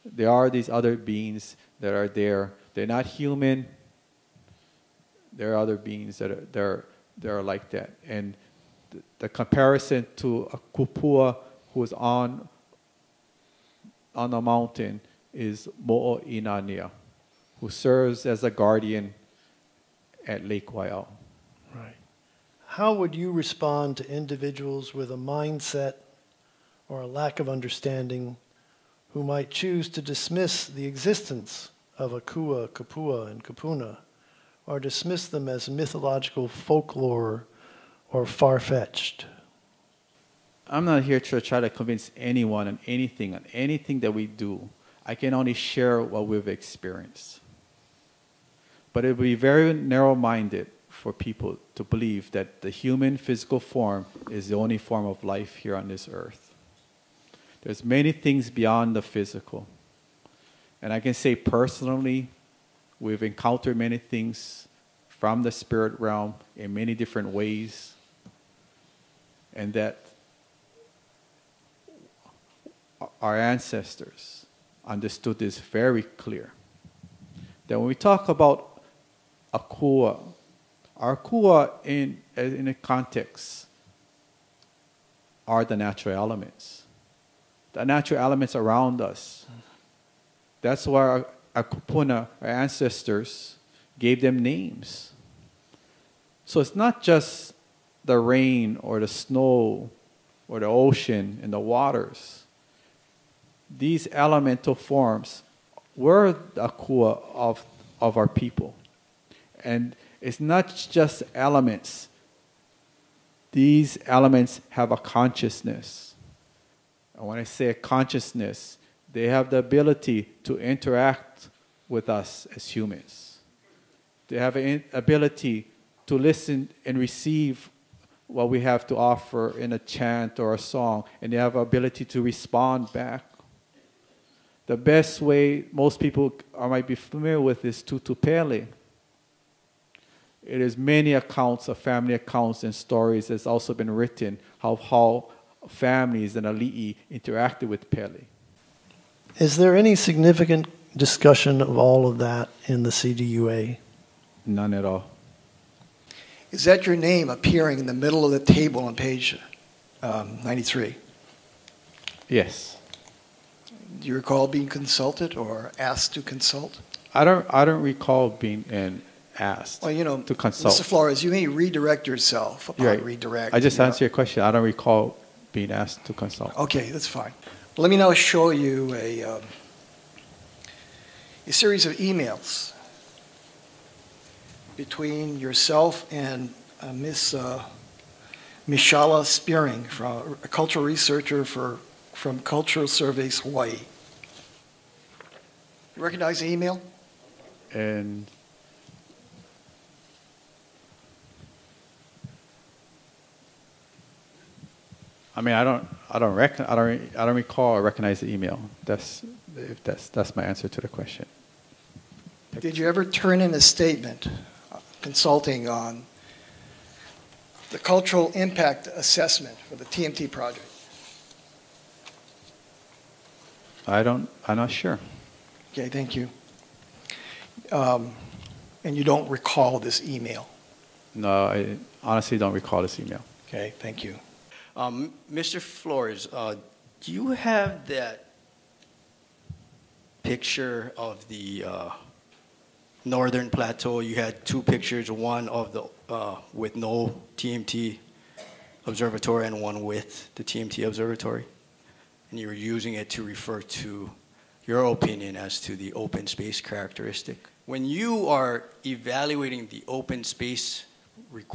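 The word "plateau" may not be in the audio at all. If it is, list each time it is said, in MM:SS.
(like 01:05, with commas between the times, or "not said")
04:03.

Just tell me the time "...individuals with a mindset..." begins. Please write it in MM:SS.
00:24.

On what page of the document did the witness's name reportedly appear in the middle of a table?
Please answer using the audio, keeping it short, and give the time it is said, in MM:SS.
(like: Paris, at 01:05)
93, at 02:40.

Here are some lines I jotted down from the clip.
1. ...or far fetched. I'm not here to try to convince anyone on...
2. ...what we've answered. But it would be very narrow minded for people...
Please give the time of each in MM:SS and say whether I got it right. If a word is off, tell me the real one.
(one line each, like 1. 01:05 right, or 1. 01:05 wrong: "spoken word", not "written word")
1. 00:38 right
2. 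00:46 wrong: "experienced", not "answered".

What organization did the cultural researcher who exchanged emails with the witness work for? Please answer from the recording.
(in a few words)
Cultural Surveys Hawaii.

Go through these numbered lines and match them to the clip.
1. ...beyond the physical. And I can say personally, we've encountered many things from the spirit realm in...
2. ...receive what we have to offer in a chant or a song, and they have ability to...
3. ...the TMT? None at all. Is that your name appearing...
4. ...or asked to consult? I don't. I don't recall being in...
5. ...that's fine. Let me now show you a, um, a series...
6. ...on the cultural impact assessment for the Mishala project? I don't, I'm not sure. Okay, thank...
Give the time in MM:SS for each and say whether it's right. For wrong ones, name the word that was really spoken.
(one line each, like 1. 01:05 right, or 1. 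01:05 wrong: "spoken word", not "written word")
1. 00:58 right
2. 02:06 right
3. 02:32 wrong: "CDUA", not "TMT"
4. 02:45 right
5. 02:56 right
6. 03:35 wrong: "TMT", not "Mishala".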